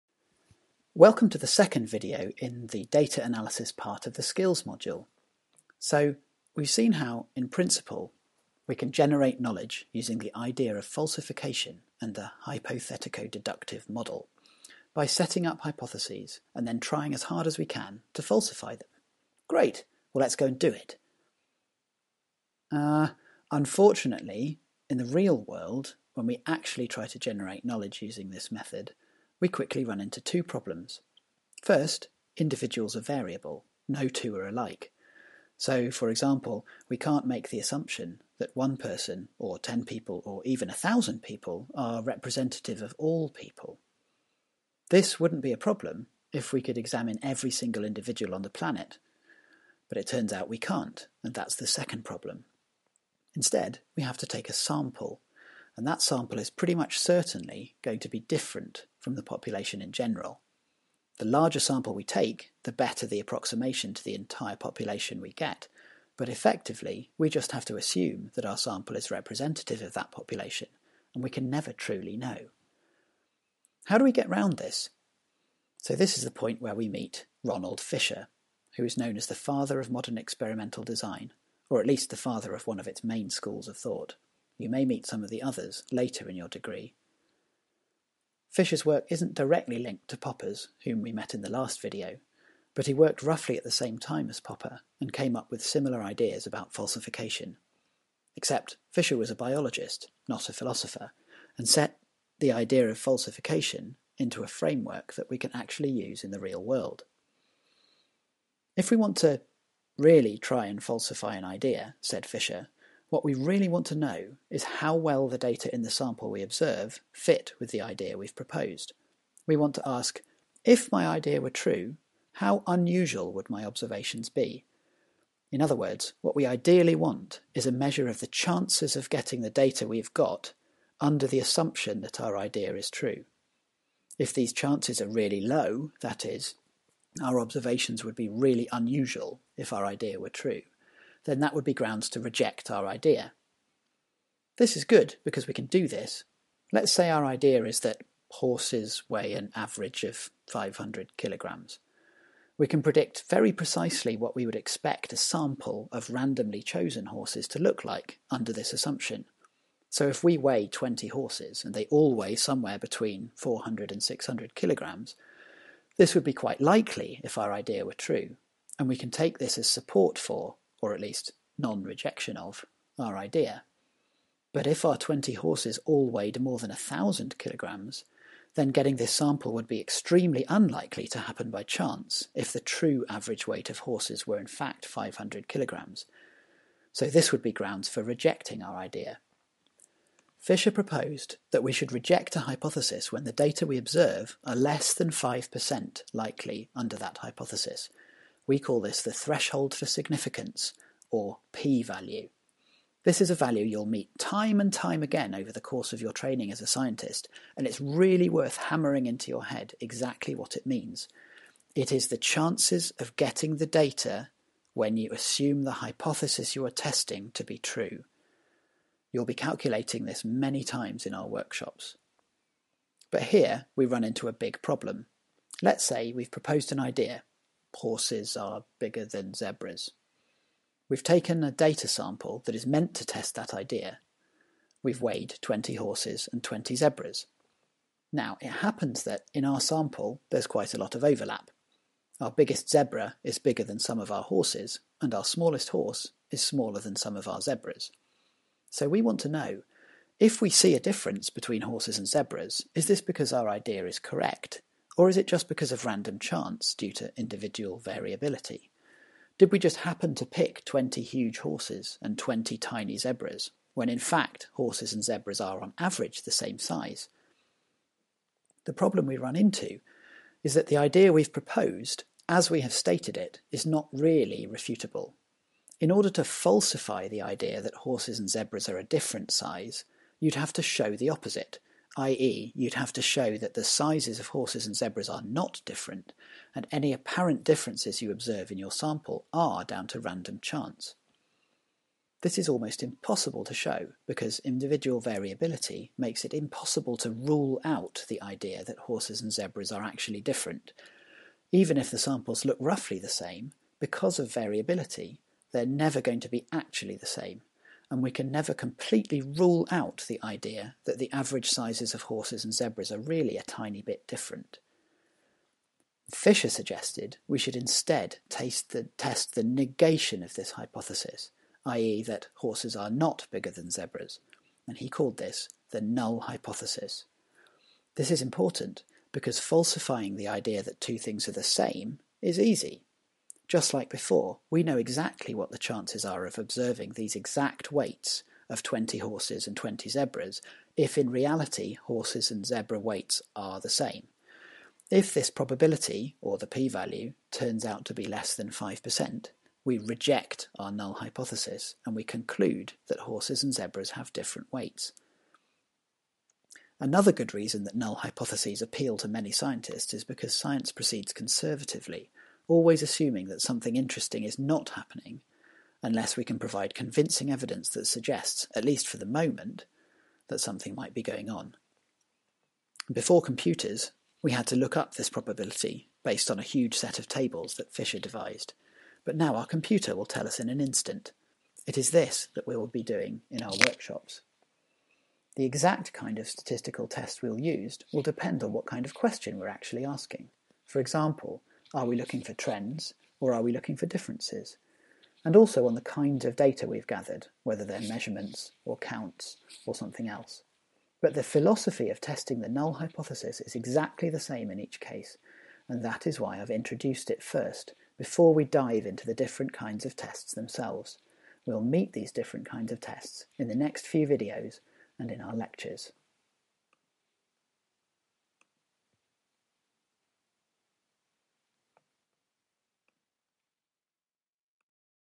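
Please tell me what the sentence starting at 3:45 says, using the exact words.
Let's say we've proposed an idea horses are bigger than zebras.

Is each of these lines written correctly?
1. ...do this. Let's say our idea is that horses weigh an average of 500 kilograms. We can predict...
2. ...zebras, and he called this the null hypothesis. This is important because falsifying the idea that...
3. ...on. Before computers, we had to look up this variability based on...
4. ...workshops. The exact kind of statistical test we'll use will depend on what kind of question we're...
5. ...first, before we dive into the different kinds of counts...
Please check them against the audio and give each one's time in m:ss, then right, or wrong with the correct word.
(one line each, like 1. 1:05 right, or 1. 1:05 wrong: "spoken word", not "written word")
1. 2:25 right
2. 5:23 right
3. 6:11 wrong: "probability", not "variability"
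4. 6:23 right
5. 6:47 wrong: "tests", not "counts".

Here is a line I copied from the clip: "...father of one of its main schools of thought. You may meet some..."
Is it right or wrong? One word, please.
right.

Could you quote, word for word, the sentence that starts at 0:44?
This wouldn't be a problem if we could examine every single individual on the planet.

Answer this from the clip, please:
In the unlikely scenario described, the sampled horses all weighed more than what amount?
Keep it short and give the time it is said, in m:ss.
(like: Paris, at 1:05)
1,000 kilograms, at 2:56.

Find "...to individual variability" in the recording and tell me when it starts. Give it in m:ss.
4:16.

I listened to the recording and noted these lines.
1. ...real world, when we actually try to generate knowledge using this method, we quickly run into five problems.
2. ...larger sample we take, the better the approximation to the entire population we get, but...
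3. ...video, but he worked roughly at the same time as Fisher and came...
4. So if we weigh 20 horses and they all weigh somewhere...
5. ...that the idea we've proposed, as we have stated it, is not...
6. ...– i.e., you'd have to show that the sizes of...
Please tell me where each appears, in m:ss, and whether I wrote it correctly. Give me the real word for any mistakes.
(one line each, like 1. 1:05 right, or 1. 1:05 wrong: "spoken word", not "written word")
1. 0:25 wrong: "two", not "five"
2. 1:01 right
3. 1:31 wrong: "Popper", not "Fisher"
4. 2:39 right
5. 4:30 right
6. 4:41 right.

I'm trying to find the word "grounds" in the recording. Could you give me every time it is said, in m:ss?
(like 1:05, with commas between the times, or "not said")
2:21, 3:07.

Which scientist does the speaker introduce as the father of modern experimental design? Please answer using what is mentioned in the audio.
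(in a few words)
Ronald Fisher.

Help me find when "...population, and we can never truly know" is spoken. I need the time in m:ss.
1:10.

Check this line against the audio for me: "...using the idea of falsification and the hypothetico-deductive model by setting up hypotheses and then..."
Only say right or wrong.
right.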